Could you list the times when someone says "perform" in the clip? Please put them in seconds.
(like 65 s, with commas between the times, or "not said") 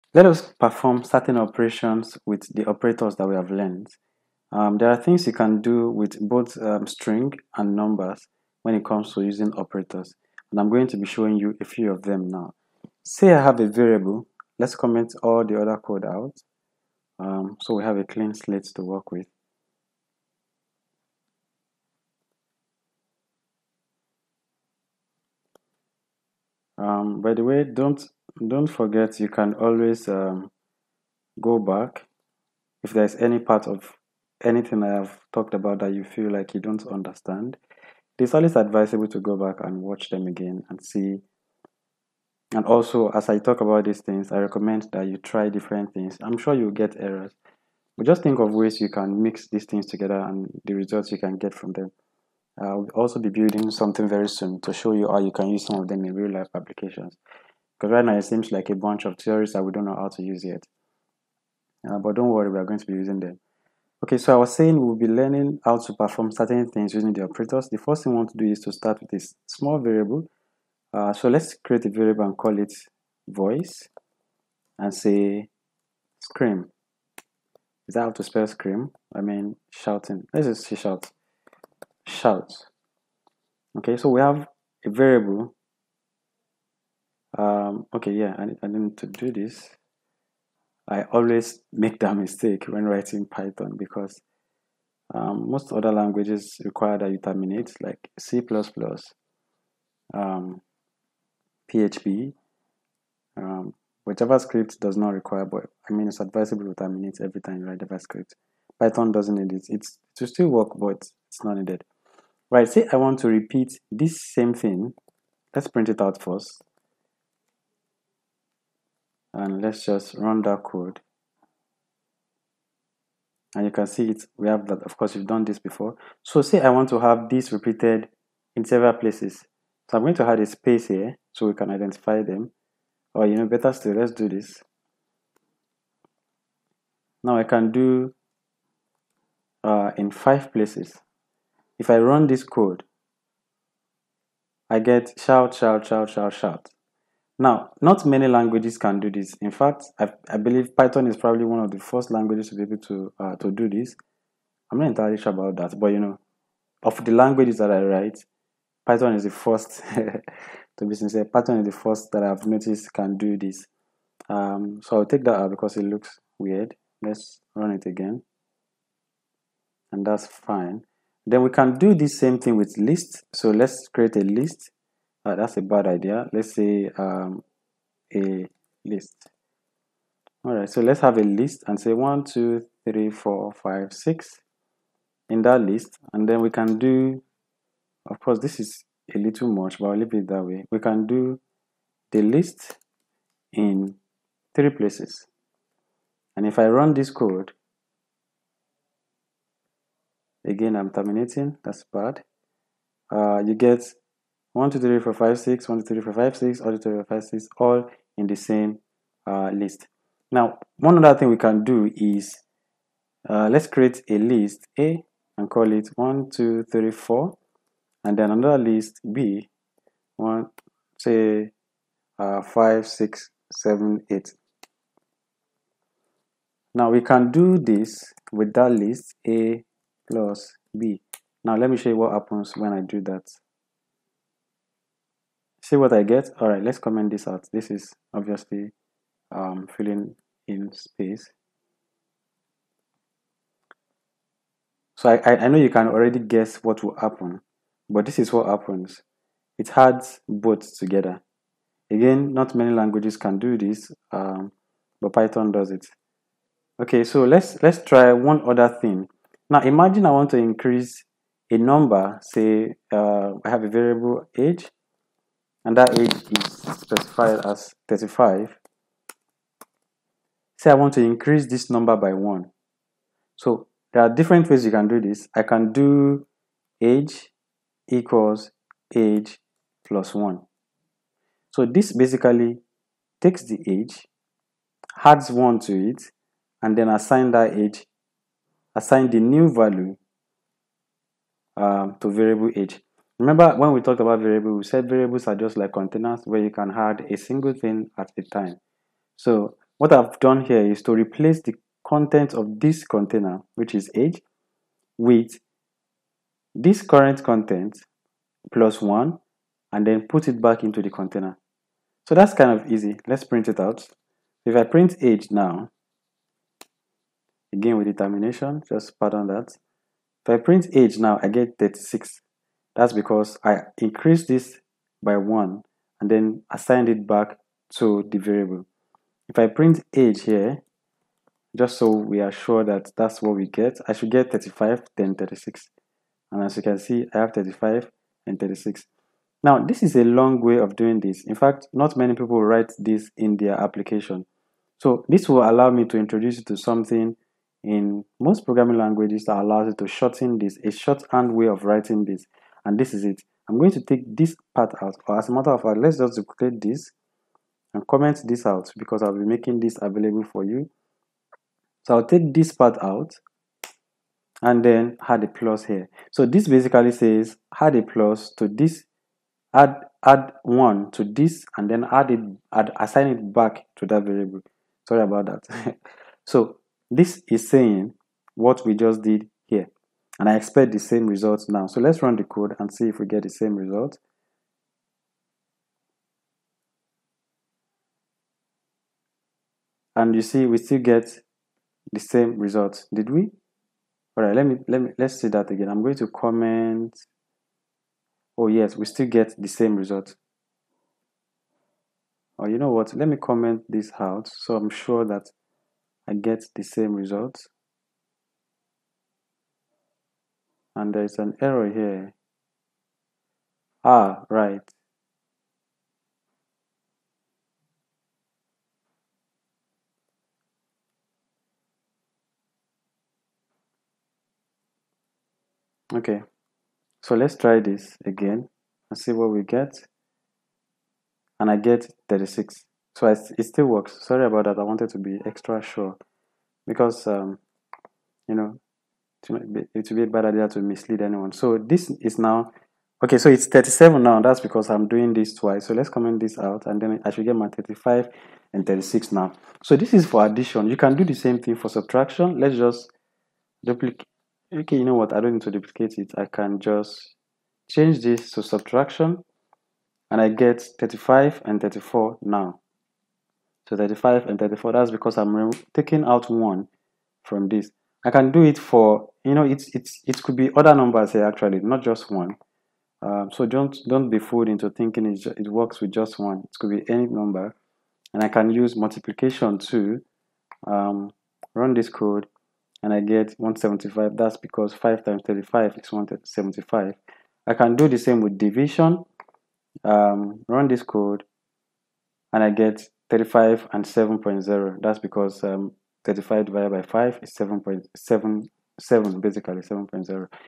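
0 s, 65 s.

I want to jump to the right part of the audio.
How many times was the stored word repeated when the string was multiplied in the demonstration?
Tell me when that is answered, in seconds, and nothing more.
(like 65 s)
139 s.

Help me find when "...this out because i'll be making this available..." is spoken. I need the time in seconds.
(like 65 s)
358 s.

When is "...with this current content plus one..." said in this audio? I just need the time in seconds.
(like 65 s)
304 s.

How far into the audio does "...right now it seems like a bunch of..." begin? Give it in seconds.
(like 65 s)
57 s.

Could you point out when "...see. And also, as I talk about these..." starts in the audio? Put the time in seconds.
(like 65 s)
40 s.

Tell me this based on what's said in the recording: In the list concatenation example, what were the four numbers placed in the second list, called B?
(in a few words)
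5, 6, 7, 8.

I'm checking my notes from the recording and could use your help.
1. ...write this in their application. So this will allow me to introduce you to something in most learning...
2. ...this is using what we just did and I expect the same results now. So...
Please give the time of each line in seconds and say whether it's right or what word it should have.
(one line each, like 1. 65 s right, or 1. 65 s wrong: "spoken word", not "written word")
1. 342 s wrong: "programming", not "learning"
2. 376 s wrong: "saying", not "using".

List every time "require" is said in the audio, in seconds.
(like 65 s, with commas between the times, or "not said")
96 s, 105 s.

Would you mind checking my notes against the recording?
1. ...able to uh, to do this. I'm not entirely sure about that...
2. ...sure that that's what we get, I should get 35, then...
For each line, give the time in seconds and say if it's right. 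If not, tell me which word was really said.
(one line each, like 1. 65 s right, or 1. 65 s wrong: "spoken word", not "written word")
1. 152 s right
2. 332 s right.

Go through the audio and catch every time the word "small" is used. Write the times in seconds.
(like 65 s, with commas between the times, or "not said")
69 s.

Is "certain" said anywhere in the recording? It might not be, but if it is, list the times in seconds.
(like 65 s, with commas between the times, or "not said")
1 s, 66 s.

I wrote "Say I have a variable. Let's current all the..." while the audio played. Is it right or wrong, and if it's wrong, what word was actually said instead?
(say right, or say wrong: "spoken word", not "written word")
wrong: "comment", not "current".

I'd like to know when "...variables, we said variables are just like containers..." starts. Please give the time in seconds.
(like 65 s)
294 s.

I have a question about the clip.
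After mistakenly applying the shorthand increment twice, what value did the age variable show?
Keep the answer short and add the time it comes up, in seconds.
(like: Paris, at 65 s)
37, at 443 s.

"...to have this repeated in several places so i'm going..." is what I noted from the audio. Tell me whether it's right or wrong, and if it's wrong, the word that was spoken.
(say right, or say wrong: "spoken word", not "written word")
right.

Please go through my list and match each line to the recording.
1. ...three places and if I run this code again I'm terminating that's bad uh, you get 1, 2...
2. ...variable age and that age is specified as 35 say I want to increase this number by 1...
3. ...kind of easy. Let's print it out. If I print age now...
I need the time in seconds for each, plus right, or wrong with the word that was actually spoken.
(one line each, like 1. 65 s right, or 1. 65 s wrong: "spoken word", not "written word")
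1. 194 s right
2. 263 s right
3. 312 s right.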